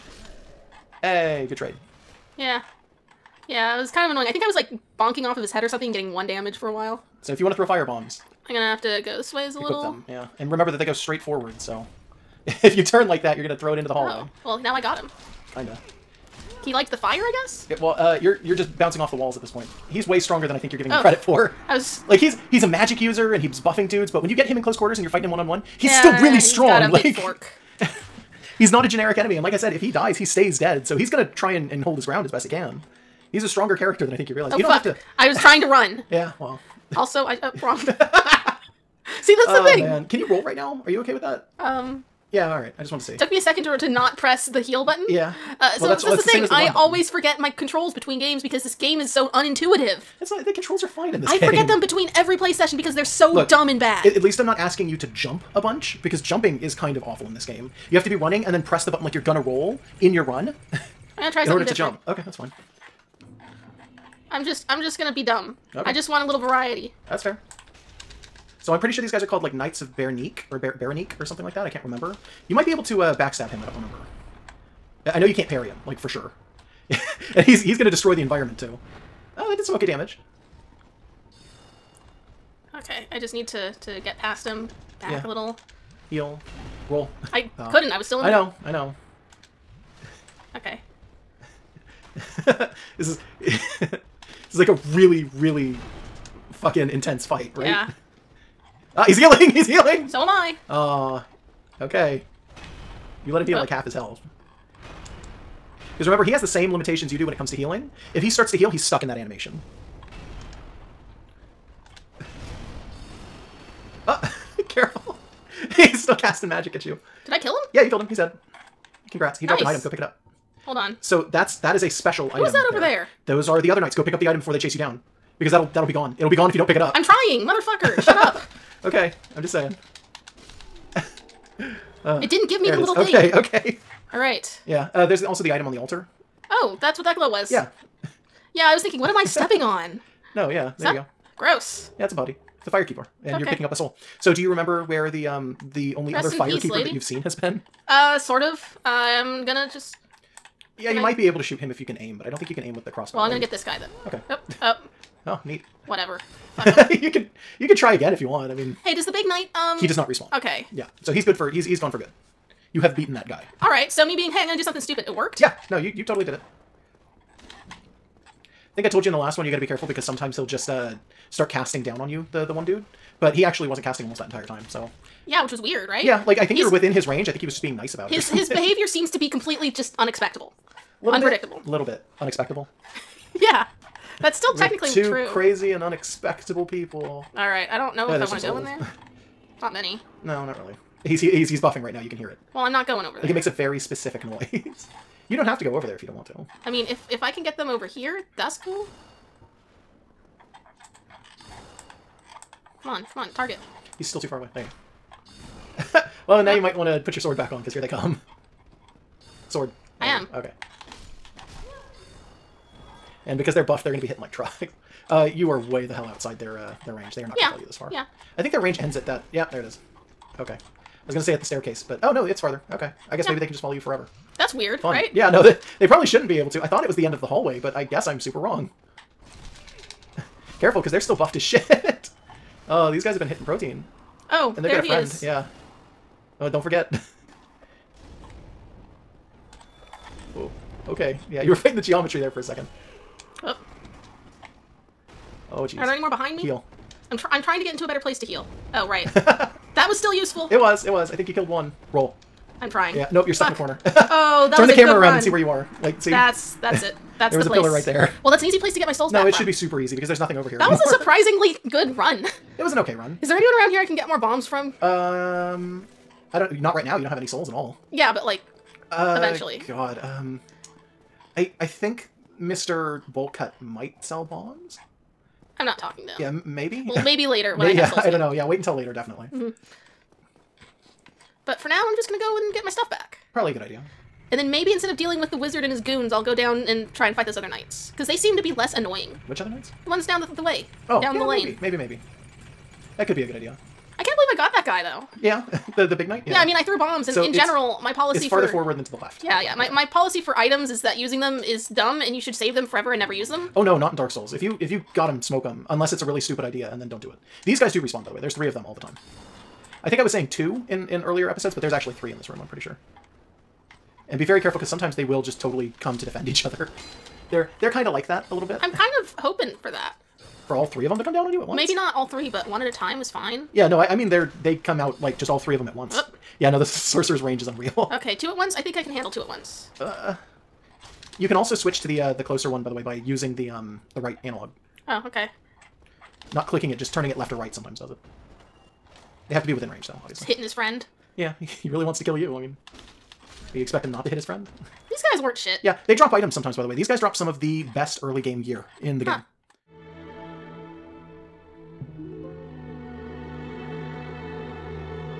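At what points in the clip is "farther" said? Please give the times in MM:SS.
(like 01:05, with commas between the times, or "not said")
03:42, 04:58.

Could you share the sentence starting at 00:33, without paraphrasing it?
He's a stronger character than I think you realize.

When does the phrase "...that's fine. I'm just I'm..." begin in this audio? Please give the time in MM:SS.
01:02.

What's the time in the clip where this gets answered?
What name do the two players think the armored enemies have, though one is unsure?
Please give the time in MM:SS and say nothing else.
01:09.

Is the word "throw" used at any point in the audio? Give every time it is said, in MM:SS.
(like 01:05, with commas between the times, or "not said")
00:07, 00:13.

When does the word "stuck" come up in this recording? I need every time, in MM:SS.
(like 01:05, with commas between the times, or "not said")
01:48, 04:13.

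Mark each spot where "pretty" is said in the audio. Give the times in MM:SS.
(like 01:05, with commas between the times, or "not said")
01:08, 05:12.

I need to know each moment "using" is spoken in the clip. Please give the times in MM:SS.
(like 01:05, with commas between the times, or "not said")
05:00, 05:32.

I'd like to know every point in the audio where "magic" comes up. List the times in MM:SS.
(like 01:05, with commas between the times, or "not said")
00:22, 01:56.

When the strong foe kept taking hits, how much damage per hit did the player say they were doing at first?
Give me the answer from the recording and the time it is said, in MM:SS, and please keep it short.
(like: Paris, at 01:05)
1, at 00:06.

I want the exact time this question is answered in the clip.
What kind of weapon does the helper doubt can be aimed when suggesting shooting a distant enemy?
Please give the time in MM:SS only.
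02:32.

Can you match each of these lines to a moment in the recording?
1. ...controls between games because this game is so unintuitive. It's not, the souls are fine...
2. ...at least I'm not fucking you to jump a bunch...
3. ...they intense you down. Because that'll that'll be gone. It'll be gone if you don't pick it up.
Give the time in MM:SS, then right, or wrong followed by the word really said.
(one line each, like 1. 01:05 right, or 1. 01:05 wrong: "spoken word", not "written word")
1. 00:47 wrong: "controls", not "souls"
2. 00:54 wrong: "asking", not "fucking"
3. 02:04 wrong: "chase", not "intense".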